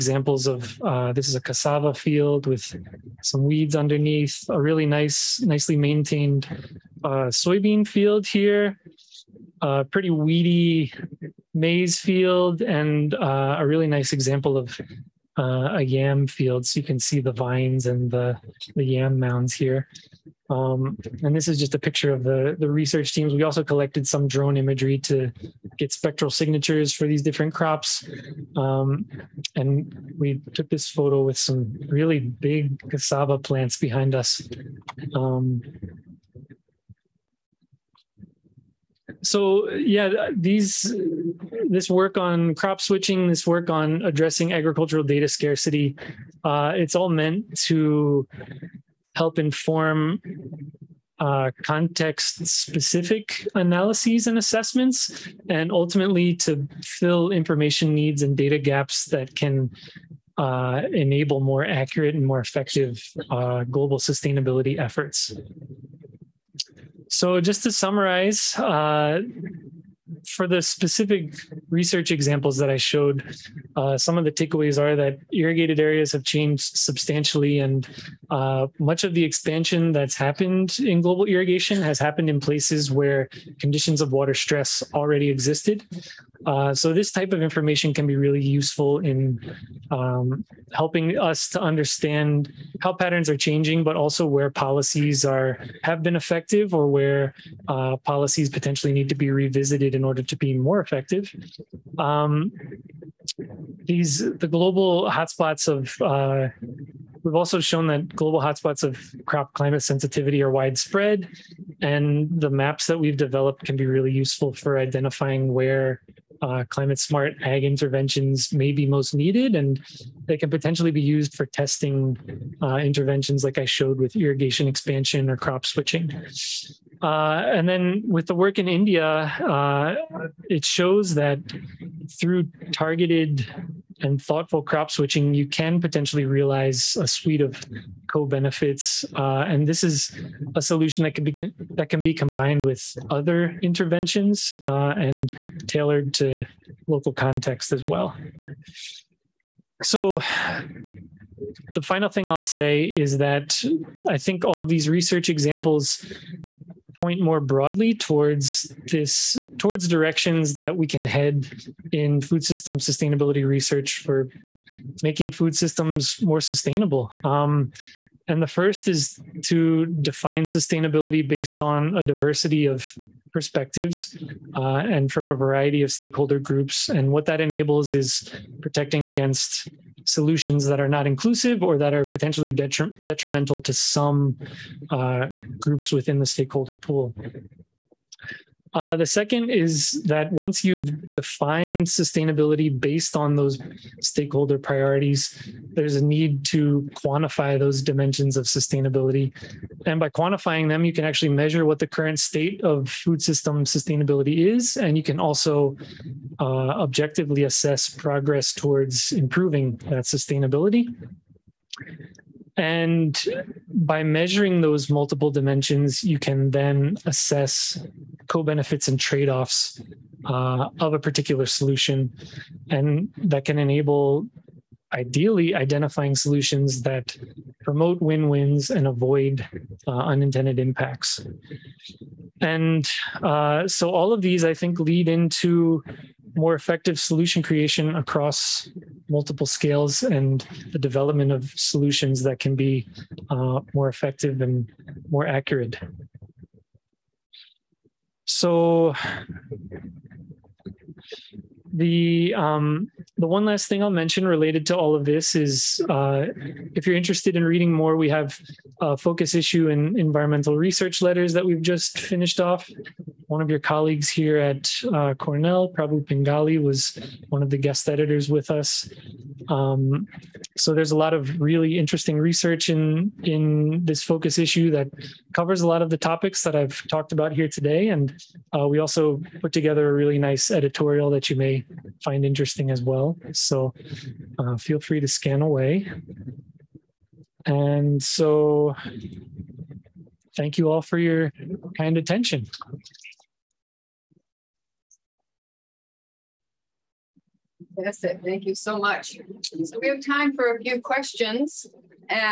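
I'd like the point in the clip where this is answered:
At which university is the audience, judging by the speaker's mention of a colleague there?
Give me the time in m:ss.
4:25.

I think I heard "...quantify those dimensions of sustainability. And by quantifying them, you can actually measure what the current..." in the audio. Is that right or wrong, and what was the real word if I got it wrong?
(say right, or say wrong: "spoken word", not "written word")
right.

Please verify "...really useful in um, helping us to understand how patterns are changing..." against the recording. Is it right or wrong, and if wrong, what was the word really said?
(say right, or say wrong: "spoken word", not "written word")
right.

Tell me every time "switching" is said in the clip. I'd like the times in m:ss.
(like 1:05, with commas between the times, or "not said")
0:42, 2:05, 2:14.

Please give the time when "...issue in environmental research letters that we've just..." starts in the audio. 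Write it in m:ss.
4:19.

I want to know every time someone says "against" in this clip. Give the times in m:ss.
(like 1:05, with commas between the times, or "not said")
2:59.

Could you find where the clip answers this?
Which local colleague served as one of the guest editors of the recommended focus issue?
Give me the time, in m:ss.
4:25.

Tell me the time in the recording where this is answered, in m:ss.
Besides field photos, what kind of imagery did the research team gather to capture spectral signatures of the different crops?
0:24.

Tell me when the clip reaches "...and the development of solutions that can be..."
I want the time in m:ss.
4:00.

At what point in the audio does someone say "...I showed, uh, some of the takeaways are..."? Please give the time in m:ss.
1:12.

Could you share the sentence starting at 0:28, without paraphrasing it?
Um, and we took this photo with some really big cassava plants behind us.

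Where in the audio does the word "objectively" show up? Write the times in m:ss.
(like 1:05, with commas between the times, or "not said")
3:26.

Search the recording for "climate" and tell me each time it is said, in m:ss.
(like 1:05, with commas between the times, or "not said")
1:49, 1:56.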